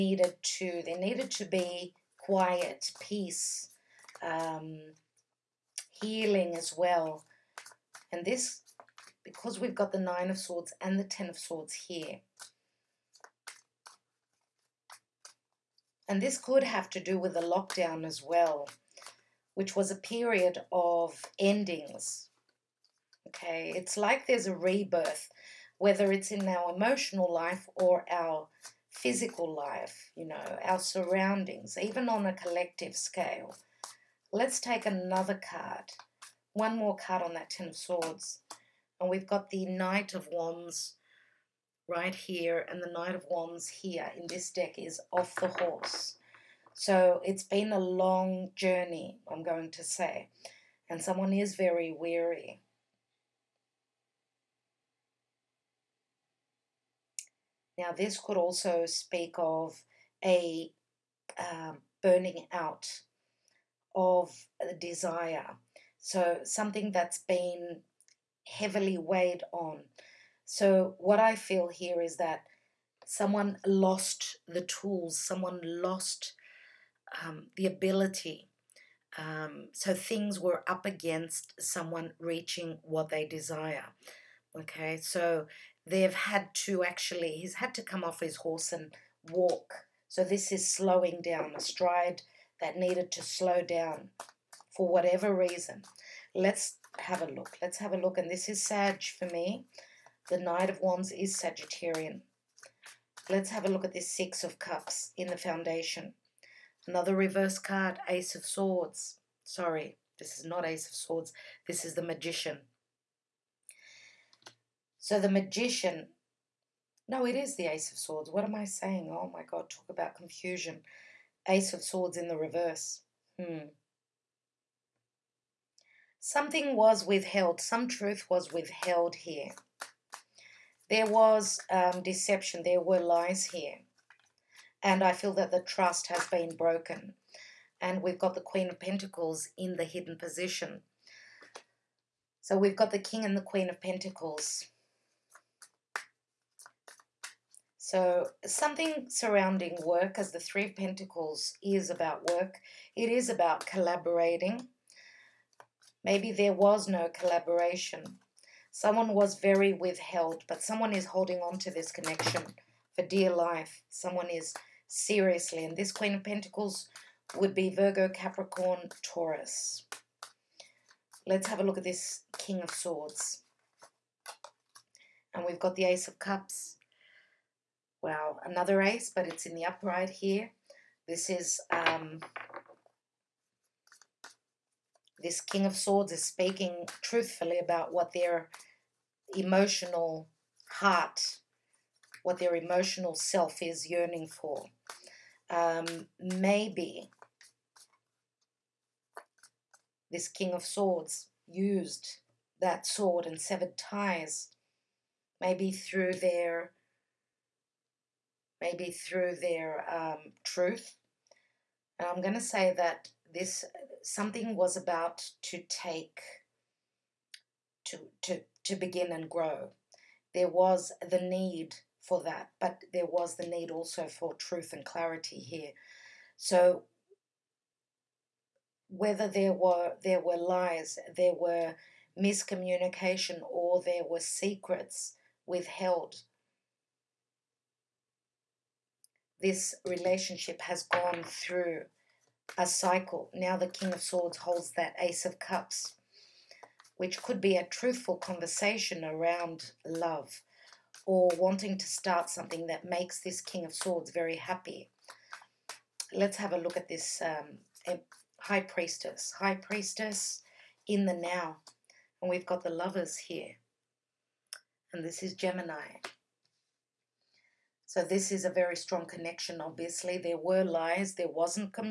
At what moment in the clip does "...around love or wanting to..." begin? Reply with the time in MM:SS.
04:09.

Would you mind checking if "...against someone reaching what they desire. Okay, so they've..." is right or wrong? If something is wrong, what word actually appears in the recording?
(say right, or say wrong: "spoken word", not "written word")
right.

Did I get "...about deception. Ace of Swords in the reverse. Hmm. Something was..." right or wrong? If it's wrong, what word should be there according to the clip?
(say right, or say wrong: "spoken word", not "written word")
wrong: "confusion", not "deception".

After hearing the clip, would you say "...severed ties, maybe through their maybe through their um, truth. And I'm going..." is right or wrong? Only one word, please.
right.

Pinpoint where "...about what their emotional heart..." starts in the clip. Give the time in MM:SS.
03:07.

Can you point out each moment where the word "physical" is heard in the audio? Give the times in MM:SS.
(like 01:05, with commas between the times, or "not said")
00:28.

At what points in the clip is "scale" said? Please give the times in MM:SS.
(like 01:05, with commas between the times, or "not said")
00:32.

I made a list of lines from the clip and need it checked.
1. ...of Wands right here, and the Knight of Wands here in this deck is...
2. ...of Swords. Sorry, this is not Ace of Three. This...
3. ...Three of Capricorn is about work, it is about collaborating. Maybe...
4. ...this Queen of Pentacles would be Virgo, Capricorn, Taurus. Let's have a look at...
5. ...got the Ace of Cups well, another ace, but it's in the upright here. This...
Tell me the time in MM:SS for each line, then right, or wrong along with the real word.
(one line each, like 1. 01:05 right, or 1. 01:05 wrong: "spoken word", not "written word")
1. 00:40 right
2. 01:48 wrong: "Swords", not "Three"
3. 02:30 wrong: "Pentacles", not "Capricorn"
4. 02:45 right
5. 02:55 right.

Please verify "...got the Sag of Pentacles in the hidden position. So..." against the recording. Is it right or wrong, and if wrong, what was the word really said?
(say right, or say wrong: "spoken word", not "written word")
wrong: "Queen", not "Sag".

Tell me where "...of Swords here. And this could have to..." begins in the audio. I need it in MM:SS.
00:11.